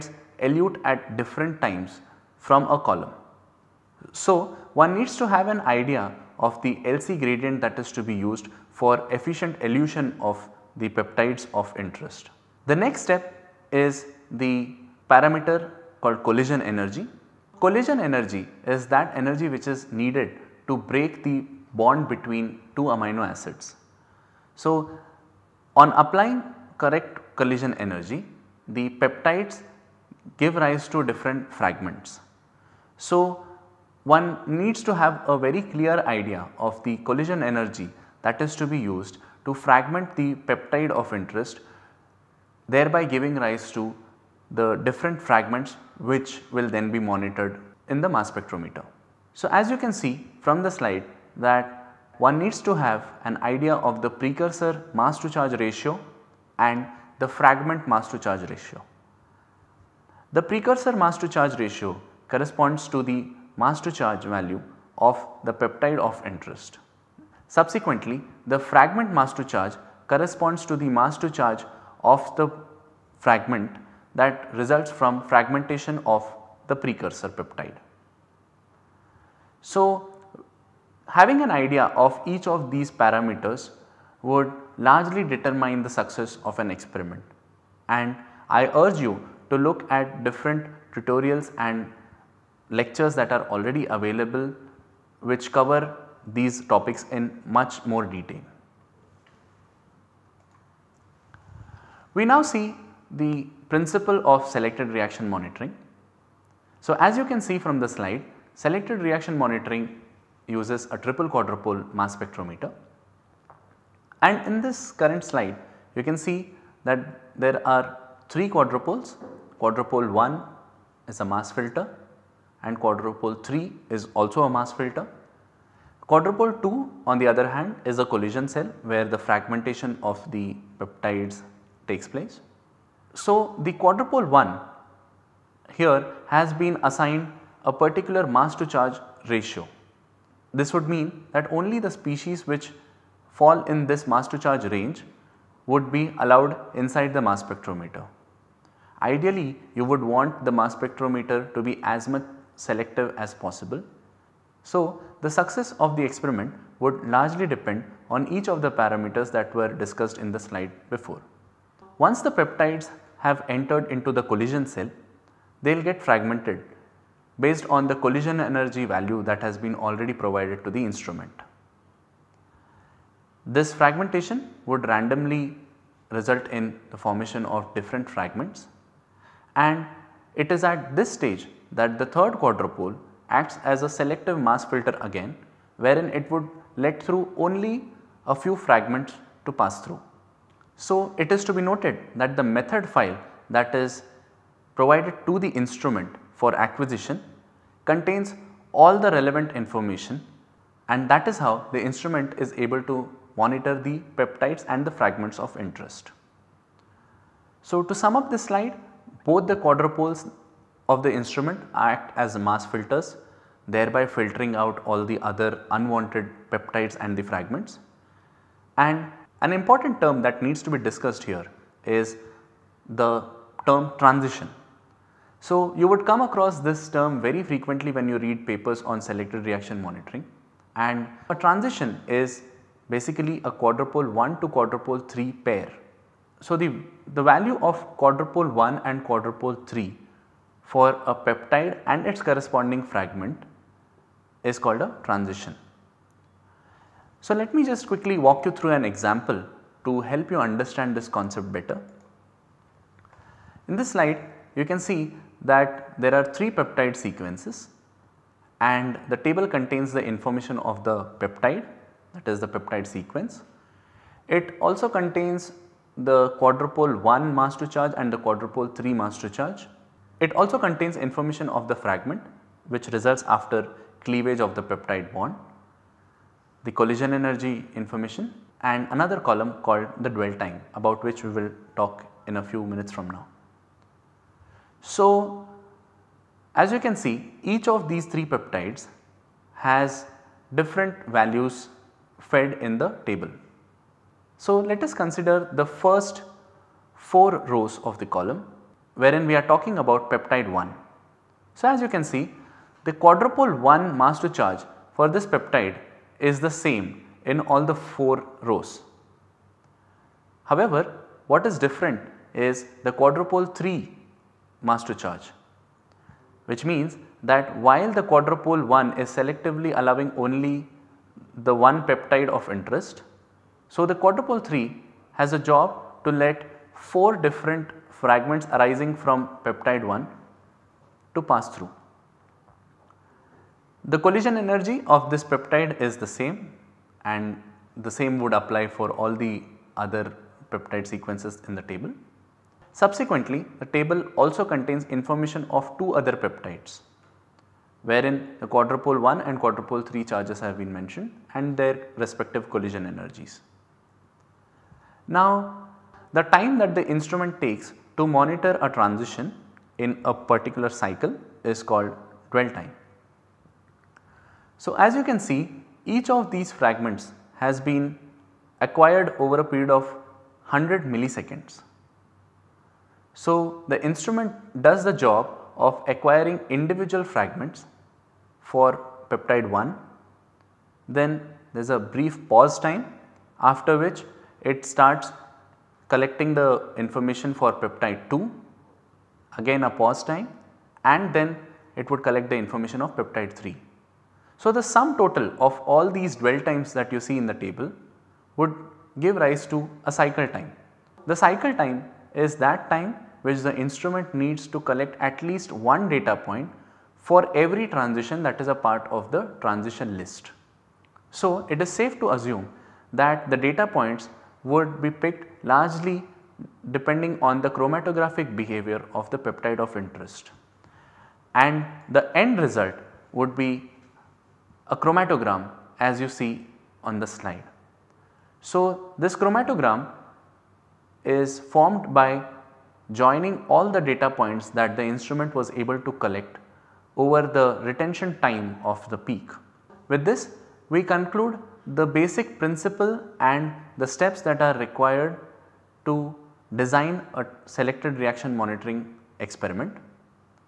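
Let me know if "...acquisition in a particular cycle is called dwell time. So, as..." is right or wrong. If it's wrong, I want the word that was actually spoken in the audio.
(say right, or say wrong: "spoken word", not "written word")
wrong: "transition", not "acquisition".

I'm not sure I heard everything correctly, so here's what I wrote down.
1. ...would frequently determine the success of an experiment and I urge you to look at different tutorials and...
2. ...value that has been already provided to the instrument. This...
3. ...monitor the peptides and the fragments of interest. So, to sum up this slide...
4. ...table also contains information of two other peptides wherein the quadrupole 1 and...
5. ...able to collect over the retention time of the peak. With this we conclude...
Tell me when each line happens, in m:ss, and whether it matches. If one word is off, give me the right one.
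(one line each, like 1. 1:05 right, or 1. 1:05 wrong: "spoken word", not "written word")
1. 1:24 wrong: "largely", not "frequently"
2. 2:48 right
3. 3:23 right
4. 5:43 right
5. 7:15 right.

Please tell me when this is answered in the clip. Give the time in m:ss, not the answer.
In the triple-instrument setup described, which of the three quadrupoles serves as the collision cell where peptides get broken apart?
2:06.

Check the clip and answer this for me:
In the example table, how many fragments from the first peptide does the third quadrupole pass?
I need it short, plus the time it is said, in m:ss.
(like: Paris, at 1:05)
4, at 5:26.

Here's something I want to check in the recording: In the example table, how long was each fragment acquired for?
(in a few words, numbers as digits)
100 milliseconds.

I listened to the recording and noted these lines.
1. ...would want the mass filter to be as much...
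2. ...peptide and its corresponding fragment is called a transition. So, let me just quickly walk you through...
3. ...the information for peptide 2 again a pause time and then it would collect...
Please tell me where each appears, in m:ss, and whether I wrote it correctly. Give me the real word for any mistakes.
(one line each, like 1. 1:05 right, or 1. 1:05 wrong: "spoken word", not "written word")
1. 2:29 wrong: "spectrometer", not "filter"
2. 4:01 right
3. 6:26 right.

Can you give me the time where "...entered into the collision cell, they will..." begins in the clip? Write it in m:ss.
2:43.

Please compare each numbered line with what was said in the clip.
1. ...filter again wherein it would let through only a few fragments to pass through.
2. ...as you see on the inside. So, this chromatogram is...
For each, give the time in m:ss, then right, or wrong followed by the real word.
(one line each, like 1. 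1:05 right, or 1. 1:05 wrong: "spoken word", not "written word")
1. 3:04 right
2. 7:05 wrong: "slide", not "inside".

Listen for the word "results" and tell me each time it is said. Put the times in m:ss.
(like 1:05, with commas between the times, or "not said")
1:14, 2:56, 4:32, 7:02.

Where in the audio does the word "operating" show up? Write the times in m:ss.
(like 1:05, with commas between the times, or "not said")
not said.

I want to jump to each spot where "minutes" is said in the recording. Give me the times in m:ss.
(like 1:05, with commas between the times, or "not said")
4:42.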